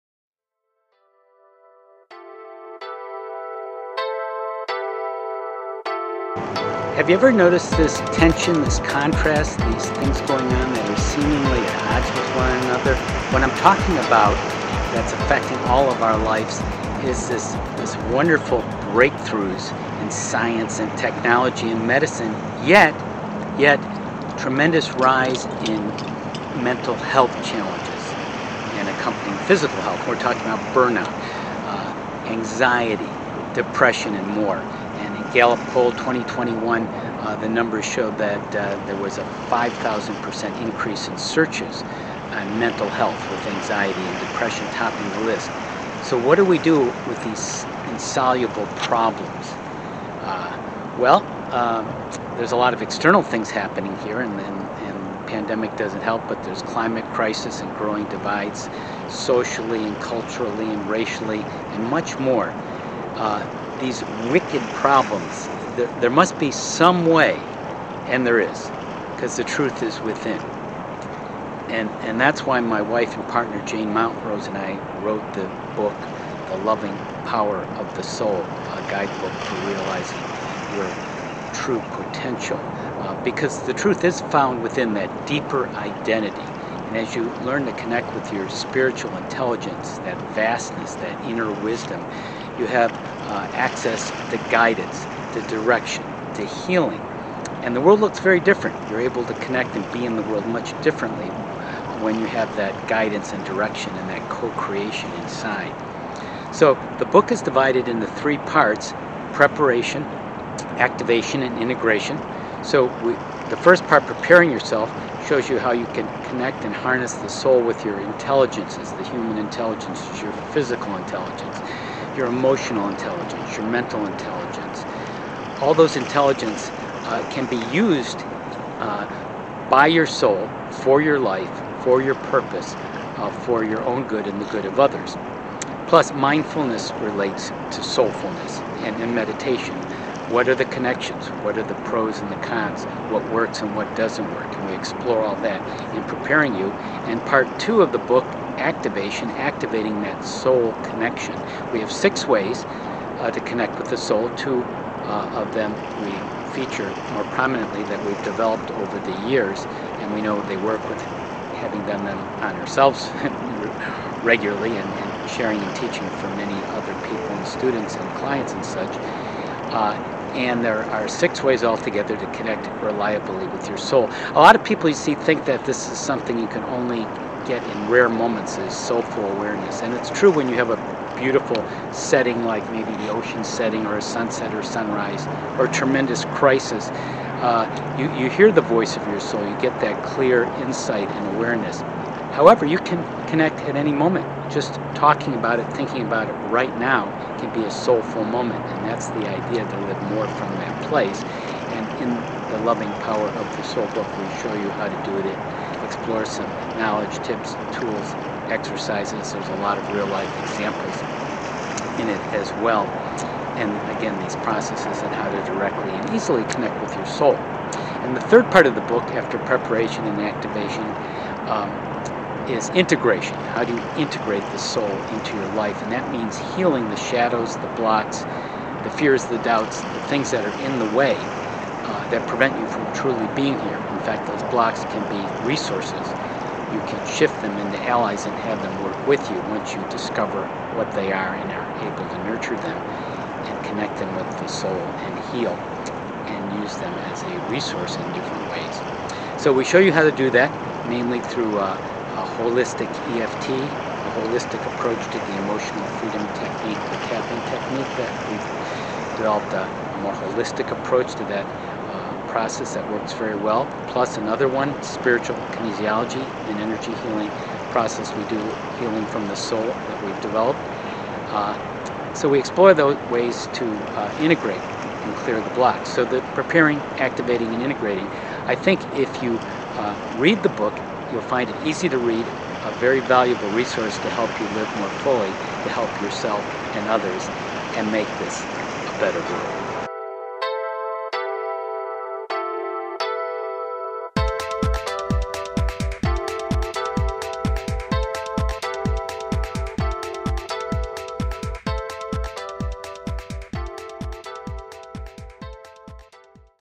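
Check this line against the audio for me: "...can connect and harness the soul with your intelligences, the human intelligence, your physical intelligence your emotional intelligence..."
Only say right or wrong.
right.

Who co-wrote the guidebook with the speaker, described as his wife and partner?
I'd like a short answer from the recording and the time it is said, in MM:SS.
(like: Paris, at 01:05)
Jane Mountrose, at 01:13.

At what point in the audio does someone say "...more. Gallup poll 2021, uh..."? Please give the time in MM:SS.
00:34.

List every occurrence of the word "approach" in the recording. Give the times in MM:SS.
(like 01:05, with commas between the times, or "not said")
04:14, 04:20.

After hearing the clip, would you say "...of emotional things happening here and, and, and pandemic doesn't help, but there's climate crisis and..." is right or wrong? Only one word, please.
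wrong.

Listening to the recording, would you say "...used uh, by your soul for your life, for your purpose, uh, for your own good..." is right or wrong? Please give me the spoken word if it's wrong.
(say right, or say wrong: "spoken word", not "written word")
right.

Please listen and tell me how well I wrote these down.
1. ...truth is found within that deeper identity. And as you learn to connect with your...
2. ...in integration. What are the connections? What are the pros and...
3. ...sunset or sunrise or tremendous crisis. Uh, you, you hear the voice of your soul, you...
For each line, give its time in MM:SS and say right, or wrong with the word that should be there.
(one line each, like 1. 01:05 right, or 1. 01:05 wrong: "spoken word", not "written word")
1. 01:23 right
2. 02:19 wrong: "meditation", not "integration"
3. 03:04 right.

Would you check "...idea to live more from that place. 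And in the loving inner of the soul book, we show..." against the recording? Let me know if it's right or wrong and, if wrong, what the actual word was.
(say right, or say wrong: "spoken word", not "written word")
wrong: "power", not "inner".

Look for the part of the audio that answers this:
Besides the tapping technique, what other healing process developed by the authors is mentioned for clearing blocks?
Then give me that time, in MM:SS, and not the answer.
04:24.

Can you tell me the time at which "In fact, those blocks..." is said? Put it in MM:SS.
03:54.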